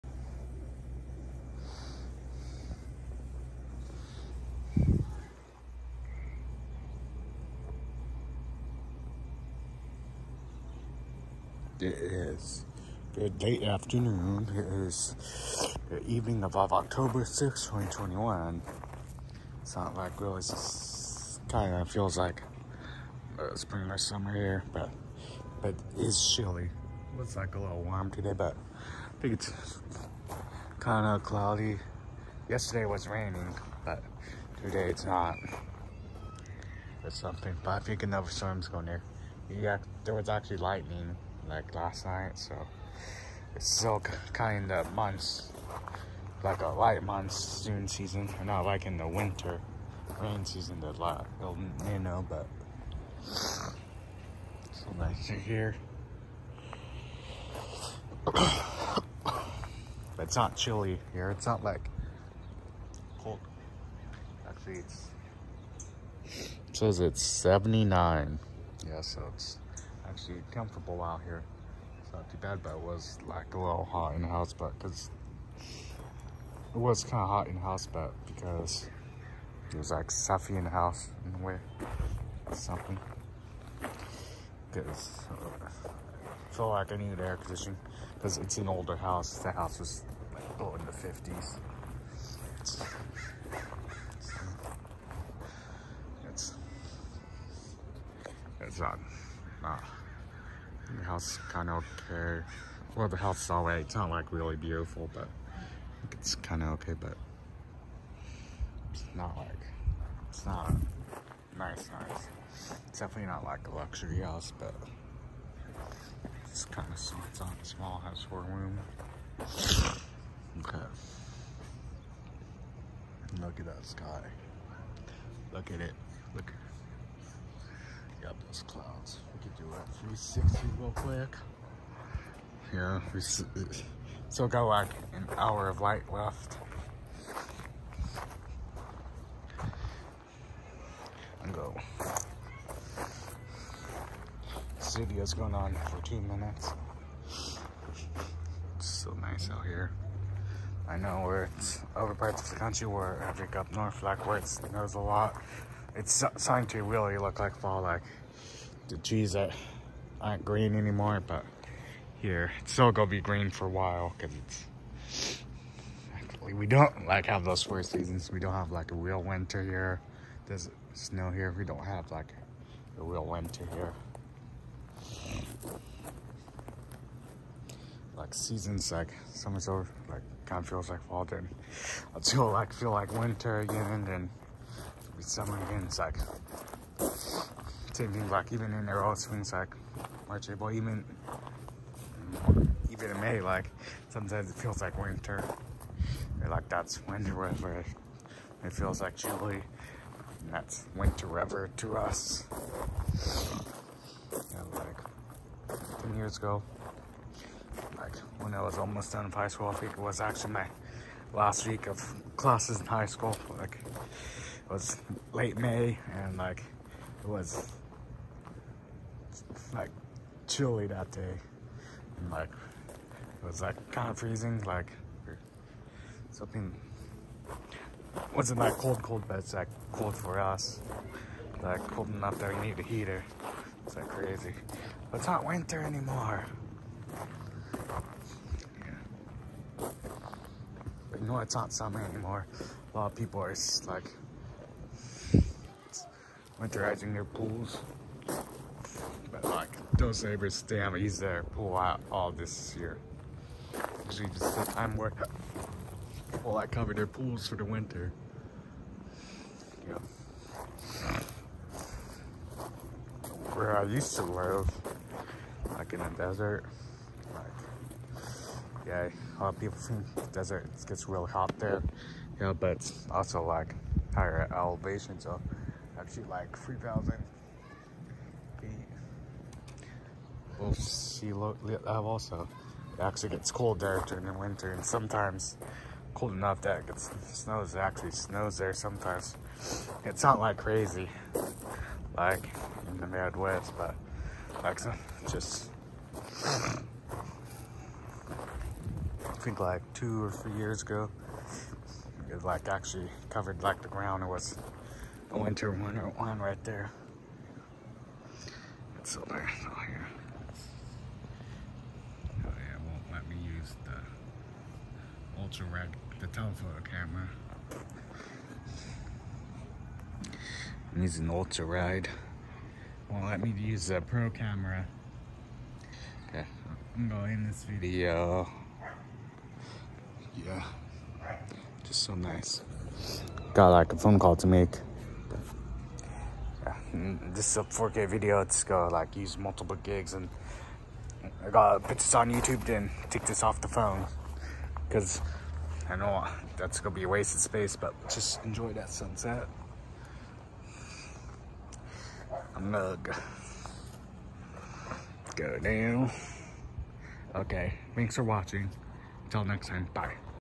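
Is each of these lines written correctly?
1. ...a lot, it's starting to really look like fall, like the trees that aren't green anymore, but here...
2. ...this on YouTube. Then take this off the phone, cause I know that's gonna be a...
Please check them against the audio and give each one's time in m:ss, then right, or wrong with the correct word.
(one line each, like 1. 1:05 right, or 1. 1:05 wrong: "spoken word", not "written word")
1. 2:34 right
2. 5:41 right.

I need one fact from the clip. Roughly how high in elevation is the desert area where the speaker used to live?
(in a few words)
3,000 feet.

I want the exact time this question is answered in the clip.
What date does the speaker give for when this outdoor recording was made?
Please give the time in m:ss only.
0:16.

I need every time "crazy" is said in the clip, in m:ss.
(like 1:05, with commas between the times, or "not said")
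3:54, 4:50.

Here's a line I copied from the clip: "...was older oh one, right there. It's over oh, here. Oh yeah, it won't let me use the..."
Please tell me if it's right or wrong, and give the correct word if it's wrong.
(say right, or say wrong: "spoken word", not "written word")
wrong: "winter", not "older".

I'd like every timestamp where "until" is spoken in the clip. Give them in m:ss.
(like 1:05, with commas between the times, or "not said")
3:02, 5:59.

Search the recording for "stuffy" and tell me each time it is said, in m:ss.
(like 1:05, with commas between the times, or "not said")
1:20.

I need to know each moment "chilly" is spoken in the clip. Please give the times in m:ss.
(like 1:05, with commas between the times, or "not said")
0:26, 1:00, 3:19, 3:40.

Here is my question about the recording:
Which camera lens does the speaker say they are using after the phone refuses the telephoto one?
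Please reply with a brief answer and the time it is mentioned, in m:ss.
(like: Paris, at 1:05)
ultra wide, at 5:21.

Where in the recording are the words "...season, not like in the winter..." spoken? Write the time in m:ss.
0:47.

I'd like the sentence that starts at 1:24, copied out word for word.
Because uh, I feel like I needed air conditioning because it's an older house.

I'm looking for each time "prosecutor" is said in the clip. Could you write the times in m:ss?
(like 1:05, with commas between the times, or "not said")
not said.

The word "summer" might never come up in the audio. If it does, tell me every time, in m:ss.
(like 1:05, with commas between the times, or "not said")
0:23, 2:59, 4:01.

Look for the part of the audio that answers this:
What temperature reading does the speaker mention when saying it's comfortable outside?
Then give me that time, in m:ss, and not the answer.
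1:07.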